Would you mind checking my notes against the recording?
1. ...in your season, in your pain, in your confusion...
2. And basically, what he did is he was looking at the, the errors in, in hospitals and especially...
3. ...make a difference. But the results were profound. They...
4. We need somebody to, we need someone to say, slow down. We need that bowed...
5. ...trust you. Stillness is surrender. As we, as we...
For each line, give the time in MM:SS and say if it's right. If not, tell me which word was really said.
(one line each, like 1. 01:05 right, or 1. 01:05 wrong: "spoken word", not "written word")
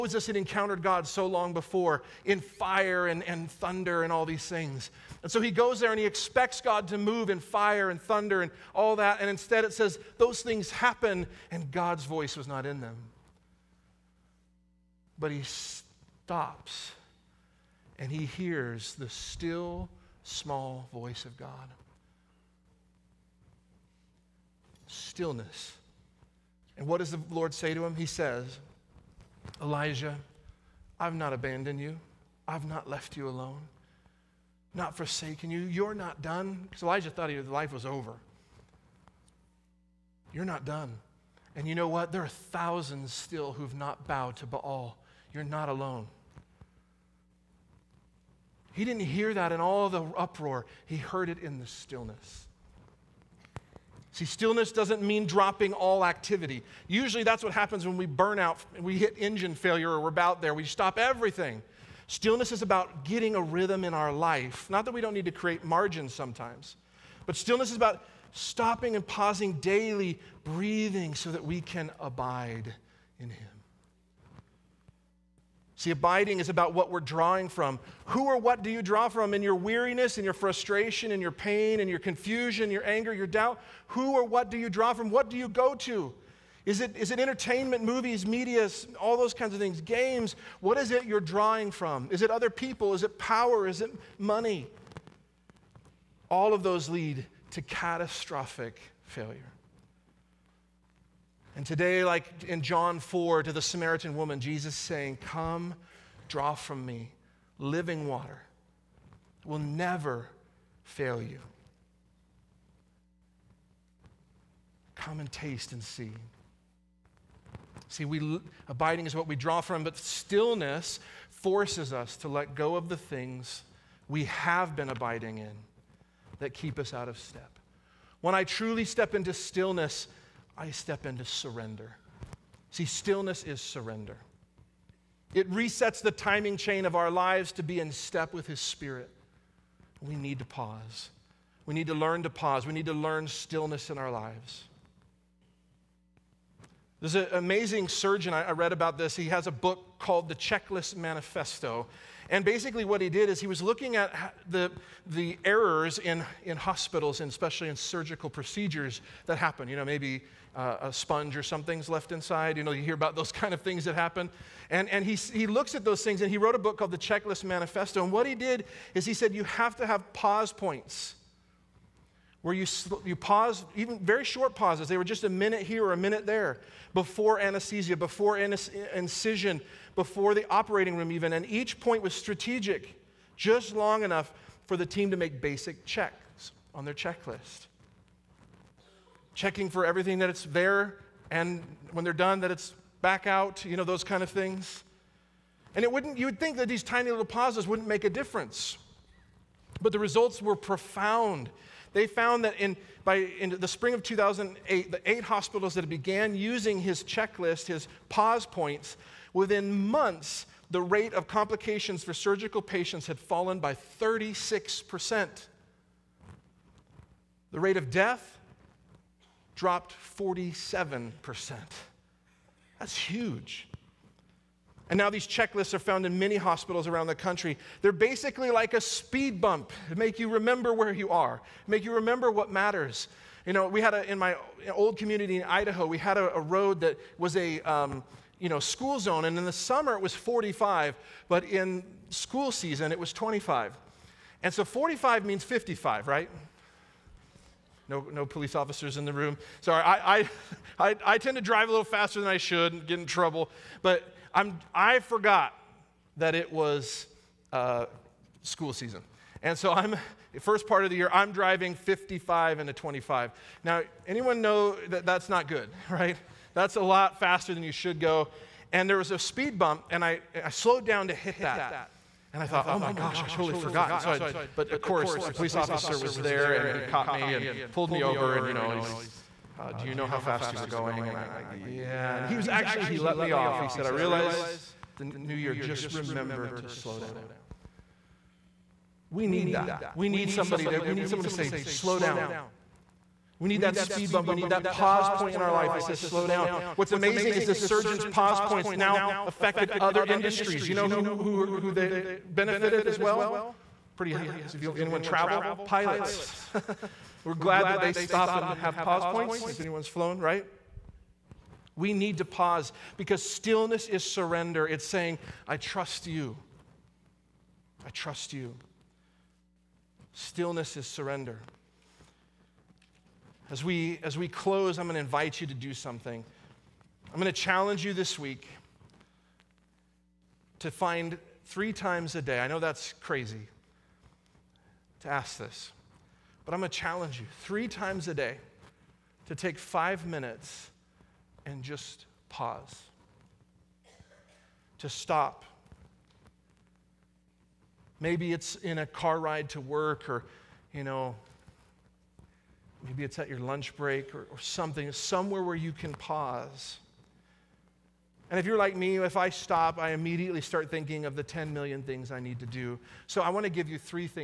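1. 01:20 wrong: "frustration", not "season"
2. 02:32 right
3. 03:17 right
4. 04:49 wrong: "speed", not "bowed"
5. 05:17 right.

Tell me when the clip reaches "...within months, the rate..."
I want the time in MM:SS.
03:29.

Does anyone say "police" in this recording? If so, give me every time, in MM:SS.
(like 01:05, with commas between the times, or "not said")
04:08, 04:35.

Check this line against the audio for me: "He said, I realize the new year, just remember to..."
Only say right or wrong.
right.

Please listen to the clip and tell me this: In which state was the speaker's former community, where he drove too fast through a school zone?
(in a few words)
Idaho.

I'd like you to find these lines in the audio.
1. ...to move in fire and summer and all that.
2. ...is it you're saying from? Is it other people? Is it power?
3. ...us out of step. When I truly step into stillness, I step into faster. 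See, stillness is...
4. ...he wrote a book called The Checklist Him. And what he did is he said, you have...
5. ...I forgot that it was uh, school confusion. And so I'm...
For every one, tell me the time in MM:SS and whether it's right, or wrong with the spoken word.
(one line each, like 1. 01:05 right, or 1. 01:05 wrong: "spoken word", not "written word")
1. 00:06 wrong: "thunder", not "summer"
2. 01:30 wrong: "drawing", not "saying"
3. 02:06 wrong: "surrender", not "faster"
4. 02:46 wrong: "Manifesto", not "Him"
5. 04:14 wrong: "season", not "confusion".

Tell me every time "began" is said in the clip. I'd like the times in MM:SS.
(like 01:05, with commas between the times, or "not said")
03:25.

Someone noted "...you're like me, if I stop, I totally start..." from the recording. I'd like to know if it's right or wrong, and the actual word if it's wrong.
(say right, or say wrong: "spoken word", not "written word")
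wrong: "immediately", not "totally".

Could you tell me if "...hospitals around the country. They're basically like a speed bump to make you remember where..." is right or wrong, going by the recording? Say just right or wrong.
right.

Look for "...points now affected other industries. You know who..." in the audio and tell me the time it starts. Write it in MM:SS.
04:58.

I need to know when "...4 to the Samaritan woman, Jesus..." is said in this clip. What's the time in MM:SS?
01:42.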